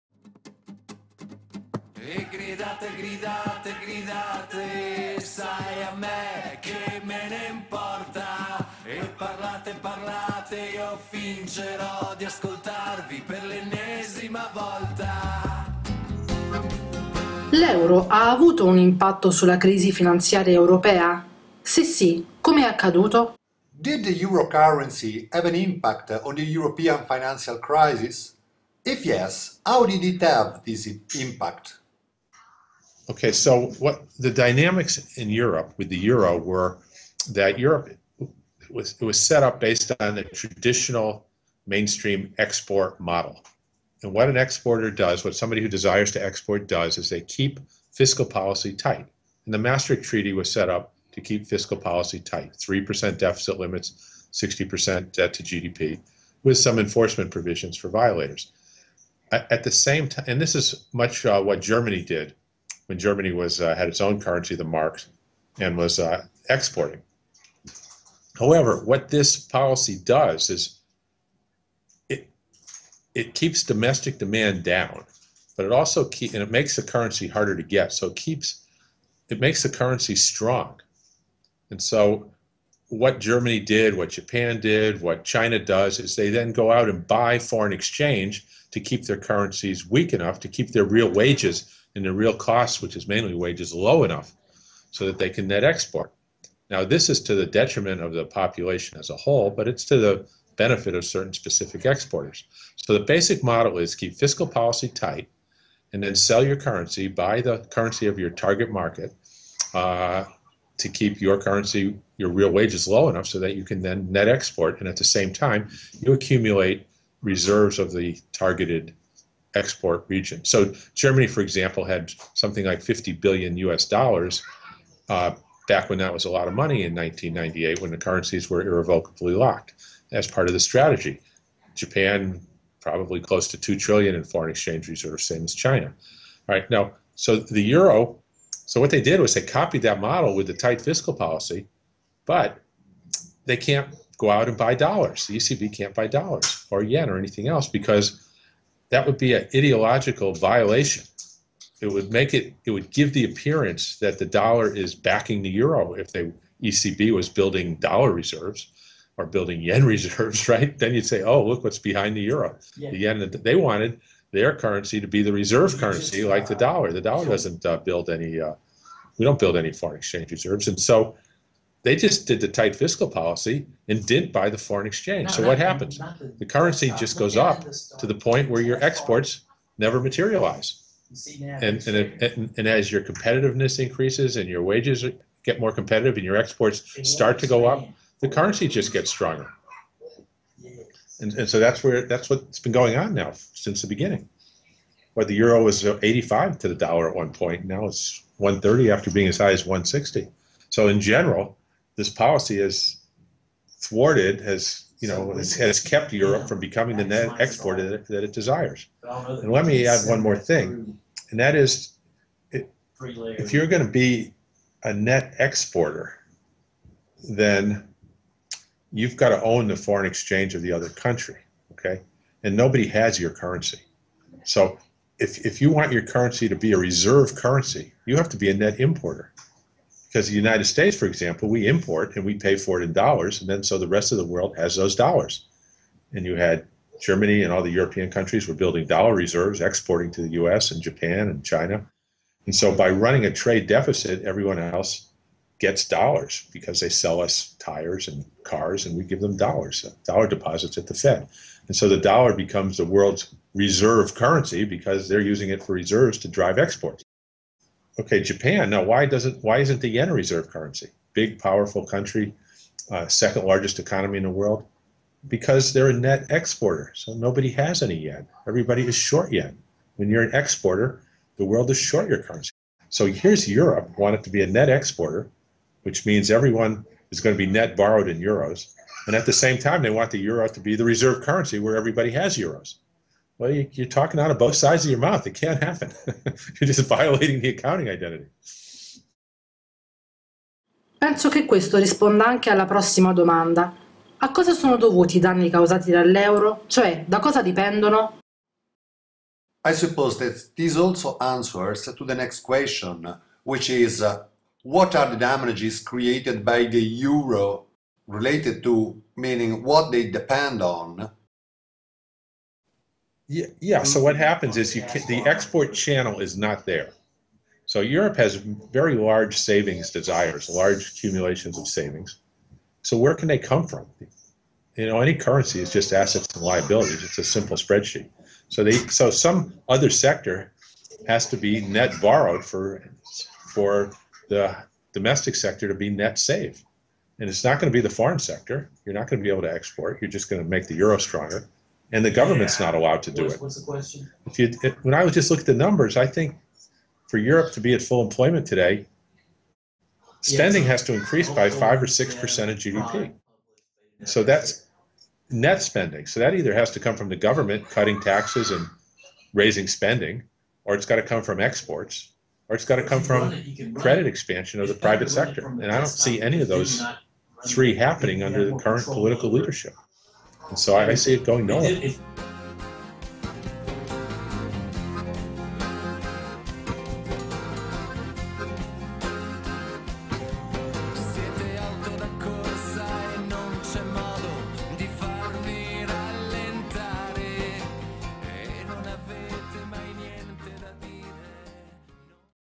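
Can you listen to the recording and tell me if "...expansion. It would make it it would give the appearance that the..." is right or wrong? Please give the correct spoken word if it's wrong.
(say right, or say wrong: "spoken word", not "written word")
wrong: "violation", not "expansion".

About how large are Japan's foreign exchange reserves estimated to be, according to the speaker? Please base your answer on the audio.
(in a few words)
2 trillion.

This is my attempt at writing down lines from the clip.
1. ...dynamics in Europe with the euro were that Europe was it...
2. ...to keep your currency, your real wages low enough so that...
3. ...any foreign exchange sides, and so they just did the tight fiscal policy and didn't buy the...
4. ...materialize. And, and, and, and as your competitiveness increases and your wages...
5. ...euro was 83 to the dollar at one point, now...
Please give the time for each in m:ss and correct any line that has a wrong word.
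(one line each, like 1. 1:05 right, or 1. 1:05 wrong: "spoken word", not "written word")
1. 0:34 right
2. 1:50 right
3. 2:49 wrong: "reserves", not "sides"
4. 2:59 right
5. 3:15 wrong: "85", not "83".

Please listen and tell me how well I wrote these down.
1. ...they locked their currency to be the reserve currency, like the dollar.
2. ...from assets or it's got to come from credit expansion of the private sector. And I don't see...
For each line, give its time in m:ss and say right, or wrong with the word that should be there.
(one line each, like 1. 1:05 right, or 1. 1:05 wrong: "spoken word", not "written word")
1. 2:43 wrong: "wanted", not "locked"
2. 6:01 wrong: "exports", not "assets".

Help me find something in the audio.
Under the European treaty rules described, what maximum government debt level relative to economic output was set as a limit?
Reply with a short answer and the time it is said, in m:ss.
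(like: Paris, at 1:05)
60% debt to GDP, at 0:54.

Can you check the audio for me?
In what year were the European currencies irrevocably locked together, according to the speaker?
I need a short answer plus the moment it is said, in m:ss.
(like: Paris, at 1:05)
1998, at 2:06.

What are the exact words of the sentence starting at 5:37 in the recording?
And it's not going to be the foreign sector.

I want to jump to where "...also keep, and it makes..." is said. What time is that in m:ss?
1:15.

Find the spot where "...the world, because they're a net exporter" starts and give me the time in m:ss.
4:24.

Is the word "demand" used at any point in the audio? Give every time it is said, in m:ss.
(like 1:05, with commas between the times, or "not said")
1:14.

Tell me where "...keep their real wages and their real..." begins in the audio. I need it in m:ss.
1:30.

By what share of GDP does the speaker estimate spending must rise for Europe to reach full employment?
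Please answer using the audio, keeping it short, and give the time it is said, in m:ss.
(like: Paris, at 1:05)
5 or 6 percent, at 5:51.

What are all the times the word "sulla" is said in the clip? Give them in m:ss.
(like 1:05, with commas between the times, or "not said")
0:19.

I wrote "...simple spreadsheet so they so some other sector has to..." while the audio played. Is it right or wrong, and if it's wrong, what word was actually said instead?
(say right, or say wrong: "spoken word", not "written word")
right.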